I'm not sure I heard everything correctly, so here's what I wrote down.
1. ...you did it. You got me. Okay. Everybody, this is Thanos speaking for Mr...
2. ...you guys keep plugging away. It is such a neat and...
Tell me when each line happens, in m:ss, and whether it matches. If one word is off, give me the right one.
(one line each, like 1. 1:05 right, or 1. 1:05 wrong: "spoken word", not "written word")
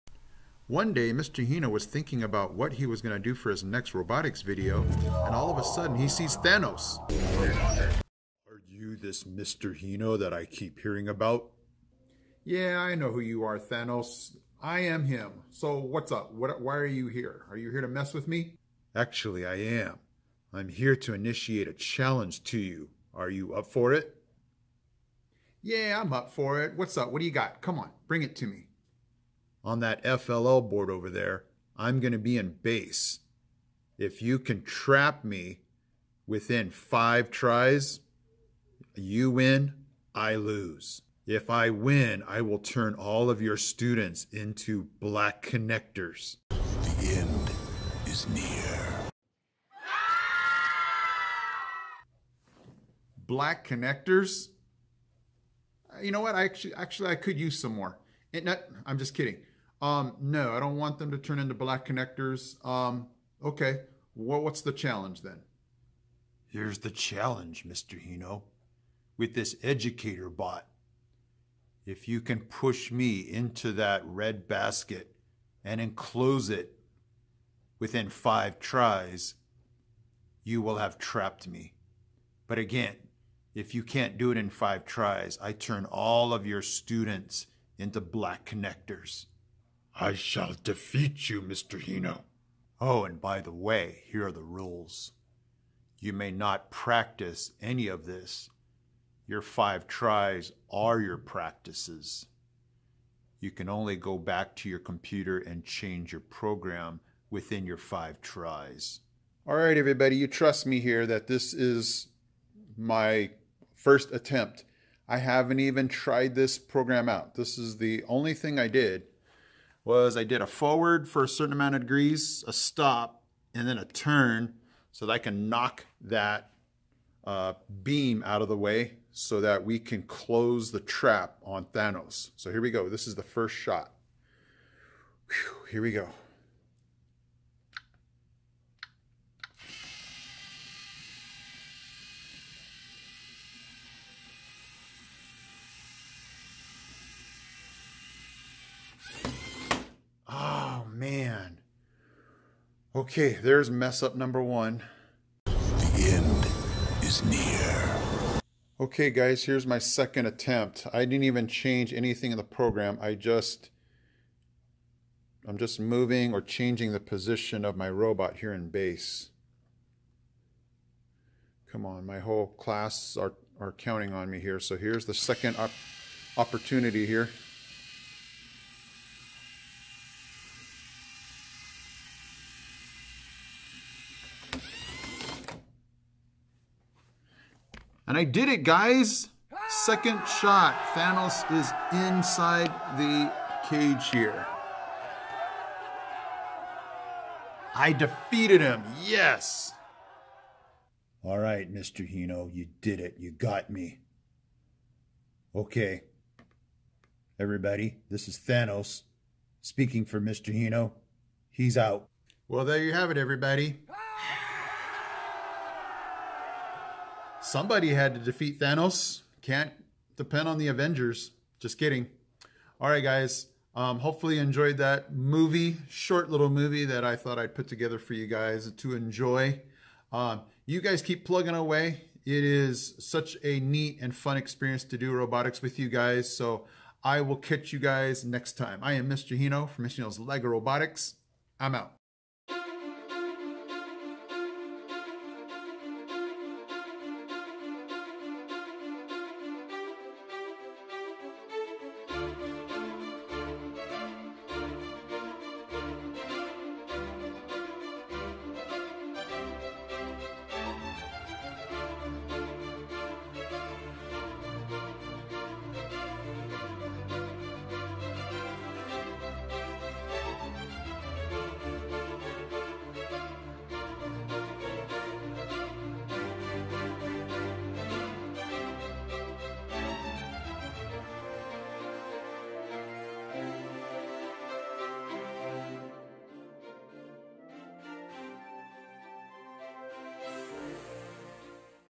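1. 3:22 right
2. 3:50 right.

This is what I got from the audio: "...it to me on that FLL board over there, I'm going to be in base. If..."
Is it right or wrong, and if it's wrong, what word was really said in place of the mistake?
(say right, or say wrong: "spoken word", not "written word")
right.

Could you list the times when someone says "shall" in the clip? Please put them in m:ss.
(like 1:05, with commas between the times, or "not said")
1:30.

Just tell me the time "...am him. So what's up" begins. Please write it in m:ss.
0:14.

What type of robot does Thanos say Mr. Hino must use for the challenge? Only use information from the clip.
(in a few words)
Educator bot.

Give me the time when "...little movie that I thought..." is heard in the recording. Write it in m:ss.
3:46.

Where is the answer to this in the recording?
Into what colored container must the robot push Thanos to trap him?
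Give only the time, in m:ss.
1:14.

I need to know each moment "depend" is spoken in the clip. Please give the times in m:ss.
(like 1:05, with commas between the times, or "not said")
3:40.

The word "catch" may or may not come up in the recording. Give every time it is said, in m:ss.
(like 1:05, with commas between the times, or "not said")
3:57.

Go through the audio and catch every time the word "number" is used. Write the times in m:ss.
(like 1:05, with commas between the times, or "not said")
2:34.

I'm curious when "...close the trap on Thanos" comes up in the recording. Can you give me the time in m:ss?
2:10.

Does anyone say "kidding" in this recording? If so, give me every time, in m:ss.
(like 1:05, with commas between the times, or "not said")
0:59, 3:41.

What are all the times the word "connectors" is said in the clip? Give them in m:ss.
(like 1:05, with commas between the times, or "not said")
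0:45, 0:53, 1:01, 1:28.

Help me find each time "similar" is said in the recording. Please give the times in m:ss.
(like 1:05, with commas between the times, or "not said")
not said.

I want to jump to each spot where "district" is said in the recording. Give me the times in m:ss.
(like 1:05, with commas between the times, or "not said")
not said.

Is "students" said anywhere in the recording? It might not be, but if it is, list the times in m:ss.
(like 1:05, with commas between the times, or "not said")
0:43, 1:26.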